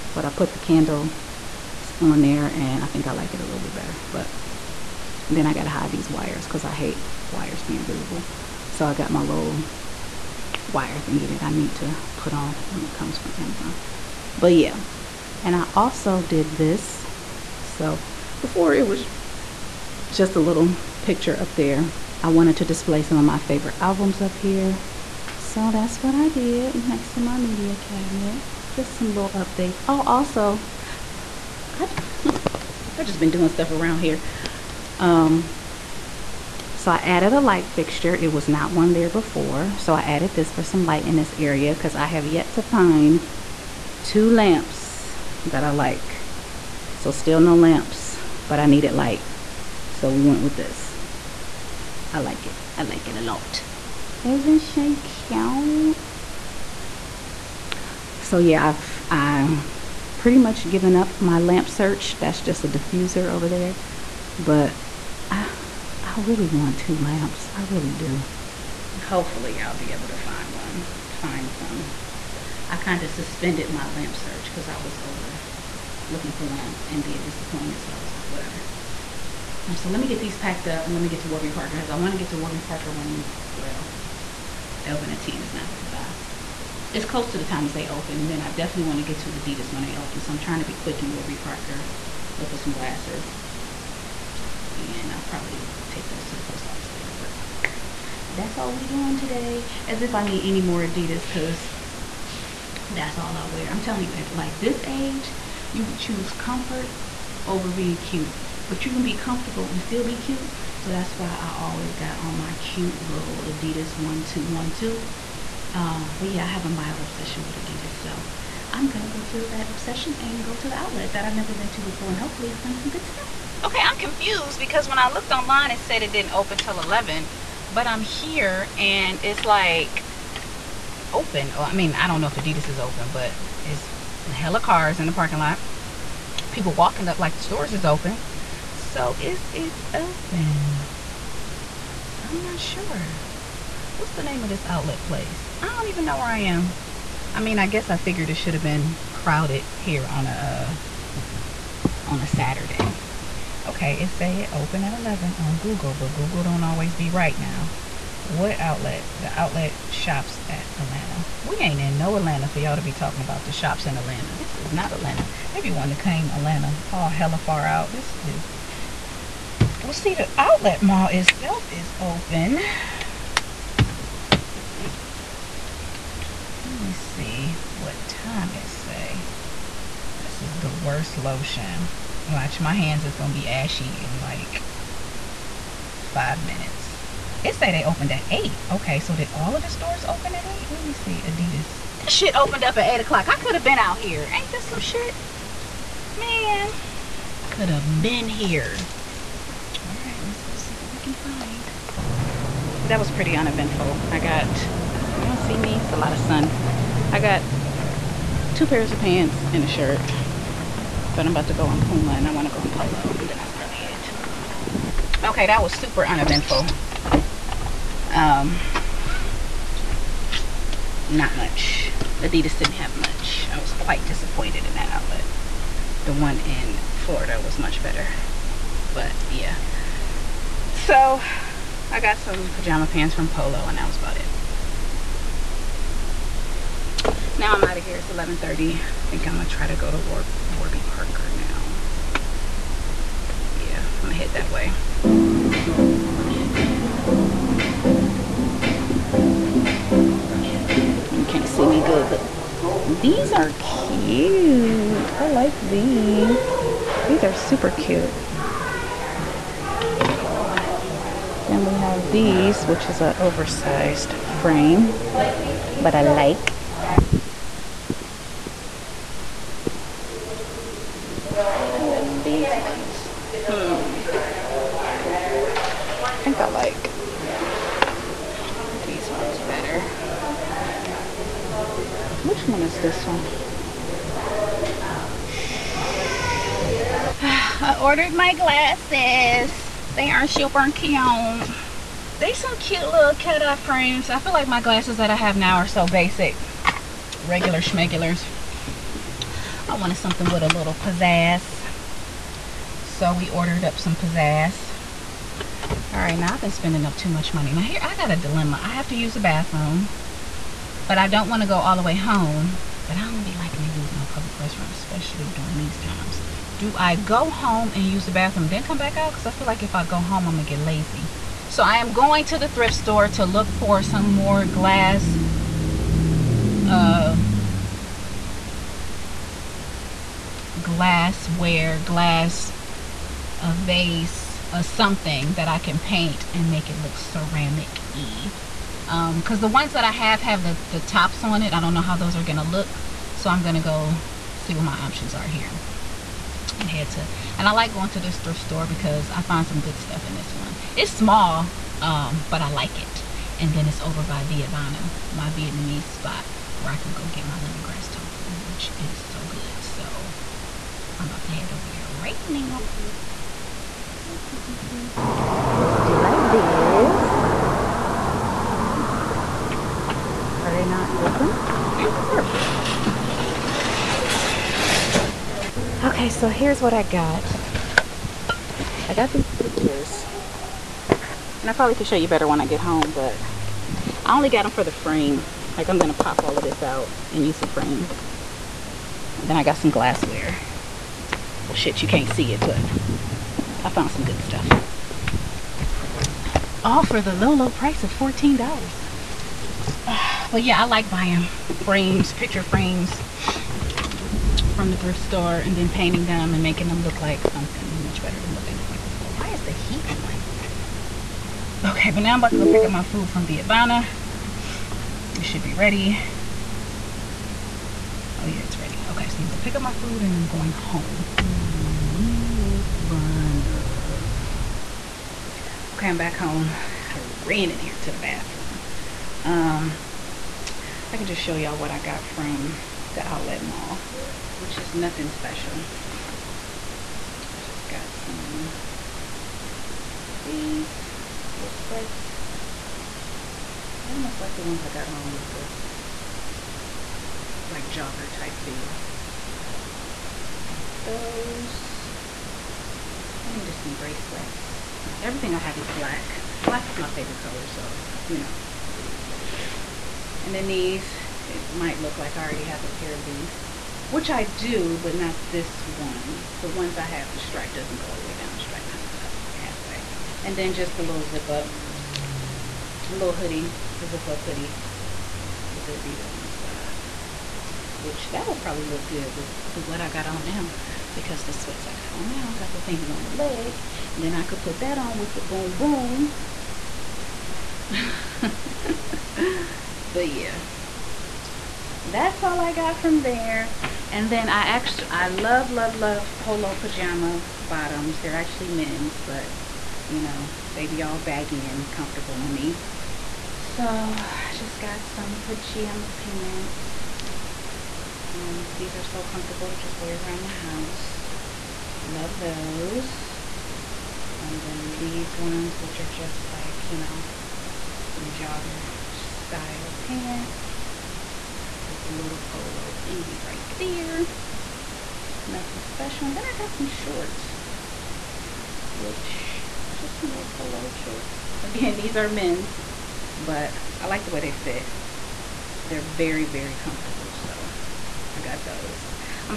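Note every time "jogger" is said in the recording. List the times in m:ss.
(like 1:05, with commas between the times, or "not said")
7:27, 8:38.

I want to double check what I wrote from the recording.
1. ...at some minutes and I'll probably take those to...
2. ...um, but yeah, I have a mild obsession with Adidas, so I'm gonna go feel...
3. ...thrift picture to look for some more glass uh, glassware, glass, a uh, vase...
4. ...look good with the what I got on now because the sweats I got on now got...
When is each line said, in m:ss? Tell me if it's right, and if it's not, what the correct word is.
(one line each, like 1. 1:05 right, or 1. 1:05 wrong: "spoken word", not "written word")
1. 1:32 wrong: "glasses", not "minutes"
2. 1:55 right
3. 5:22 wrong: "store", not "picture"
4. 7:58 right.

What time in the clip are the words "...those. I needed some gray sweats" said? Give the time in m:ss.
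7:30.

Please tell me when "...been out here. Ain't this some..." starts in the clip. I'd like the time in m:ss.
3:13.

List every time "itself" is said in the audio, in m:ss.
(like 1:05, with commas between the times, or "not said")
2:51.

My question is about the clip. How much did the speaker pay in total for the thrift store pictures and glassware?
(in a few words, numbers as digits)
$14.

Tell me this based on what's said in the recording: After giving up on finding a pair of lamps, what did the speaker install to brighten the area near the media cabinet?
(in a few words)
light fixture.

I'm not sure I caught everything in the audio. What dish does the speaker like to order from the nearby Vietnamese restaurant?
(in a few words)
lemongrass tofu.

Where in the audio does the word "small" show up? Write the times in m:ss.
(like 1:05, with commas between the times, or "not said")
5:50.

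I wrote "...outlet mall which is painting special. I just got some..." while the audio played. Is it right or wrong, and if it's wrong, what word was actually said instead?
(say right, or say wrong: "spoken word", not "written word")
wrong: "nothing", not "painting".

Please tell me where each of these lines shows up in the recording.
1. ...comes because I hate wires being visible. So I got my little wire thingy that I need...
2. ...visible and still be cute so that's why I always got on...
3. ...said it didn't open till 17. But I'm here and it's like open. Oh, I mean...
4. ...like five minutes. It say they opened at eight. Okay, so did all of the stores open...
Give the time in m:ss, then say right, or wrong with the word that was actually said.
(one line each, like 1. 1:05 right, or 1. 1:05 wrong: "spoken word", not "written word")
1. 0:06 wrong: "wires", not "comes"
2. 1:49 wrong: "comfortable", not "visible"
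3. 2:05 wrong: "11", not "17"
4. 3:04 right.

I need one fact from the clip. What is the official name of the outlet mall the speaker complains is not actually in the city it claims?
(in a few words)
The Outlet Shops at Atlanta.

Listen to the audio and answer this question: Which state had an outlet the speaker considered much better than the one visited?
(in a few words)
Florida.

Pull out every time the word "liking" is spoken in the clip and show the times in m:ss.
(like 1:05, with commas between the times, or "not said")
5:13.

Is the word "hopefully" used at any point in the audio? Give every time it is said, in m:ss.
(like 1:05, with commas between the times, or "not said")
1:09, 2:02.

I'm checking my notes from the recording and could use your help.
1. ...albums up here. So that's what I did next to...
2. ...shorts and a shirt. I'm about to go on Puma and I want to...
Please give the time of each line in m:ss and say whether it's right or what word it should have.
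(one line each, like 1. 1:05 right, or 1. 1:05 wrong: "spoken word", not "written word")
1. 0:23 right
2. 3:28 wrong: "pants", not "shorts".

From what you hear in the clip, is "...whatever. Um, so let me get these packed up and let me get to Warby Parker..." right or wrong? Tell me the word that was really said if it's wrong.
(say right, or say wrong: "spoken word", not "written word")
right.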